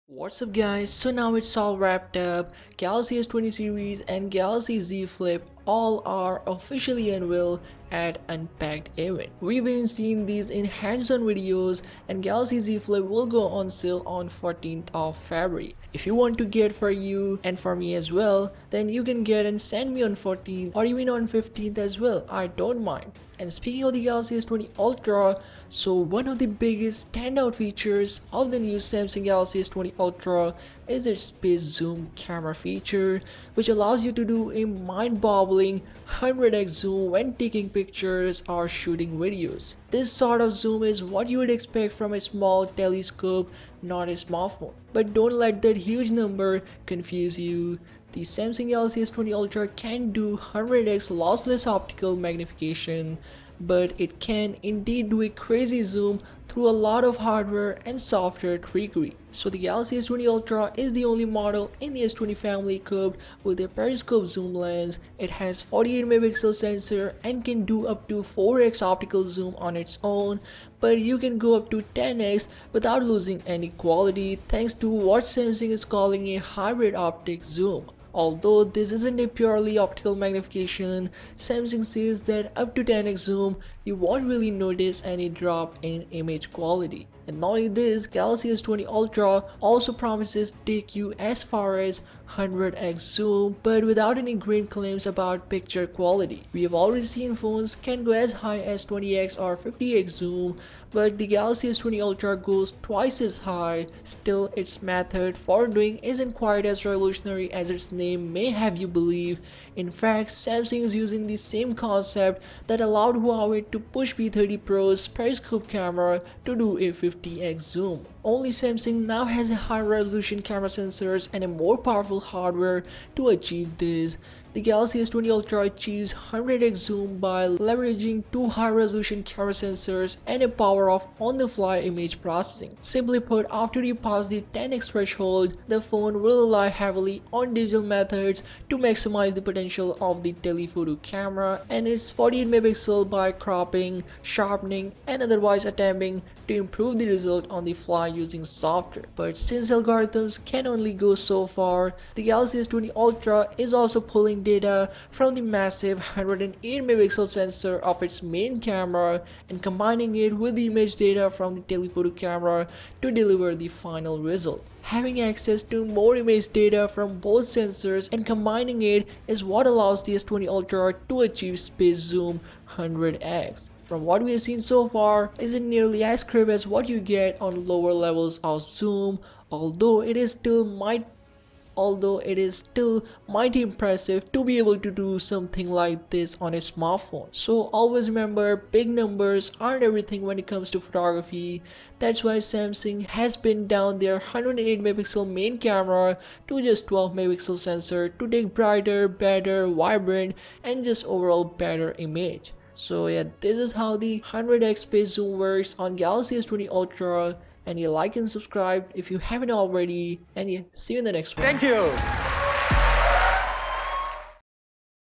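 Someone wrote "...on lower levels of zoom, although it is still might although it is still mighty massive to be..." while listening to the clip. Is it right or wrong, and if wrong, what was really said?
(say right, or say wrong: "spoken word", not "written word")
wrong: "impressive", not "massive".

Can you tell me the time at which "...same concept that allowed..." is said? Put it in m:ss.
1:51.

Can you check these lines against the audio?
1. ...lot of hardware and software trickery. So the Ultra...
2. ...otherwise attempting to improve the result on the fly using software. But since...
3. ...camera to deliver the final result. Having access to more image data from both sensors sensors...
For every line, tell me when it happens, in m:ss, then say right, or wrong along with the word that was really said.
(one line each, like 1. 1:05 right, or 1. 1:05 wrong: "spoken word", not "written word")
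1. 0:56 wrong: "Galaxy", not "Ultra"
2. 2:25 right
3. 2:42 right.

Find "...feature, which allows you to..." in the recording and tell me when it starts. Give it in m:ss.
0:32.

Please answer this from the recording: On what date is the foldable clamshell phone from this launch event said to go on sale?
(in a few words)
14th of February.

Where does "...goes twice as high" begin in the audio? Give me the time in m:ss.
1:42.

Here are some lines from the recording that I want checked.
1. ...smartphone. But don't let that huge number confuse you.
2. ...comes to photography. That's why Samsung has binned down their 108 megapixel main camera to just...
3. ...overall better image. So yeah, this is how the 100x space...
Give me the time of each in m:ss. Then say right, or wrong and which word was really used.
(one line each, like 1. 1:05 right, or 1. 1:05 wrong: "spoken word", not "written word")
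1. 0:44 right
2. 3:10 right
3. 3:21 right.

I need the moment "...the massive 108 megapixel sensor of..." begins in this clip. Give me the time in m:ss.
2:35.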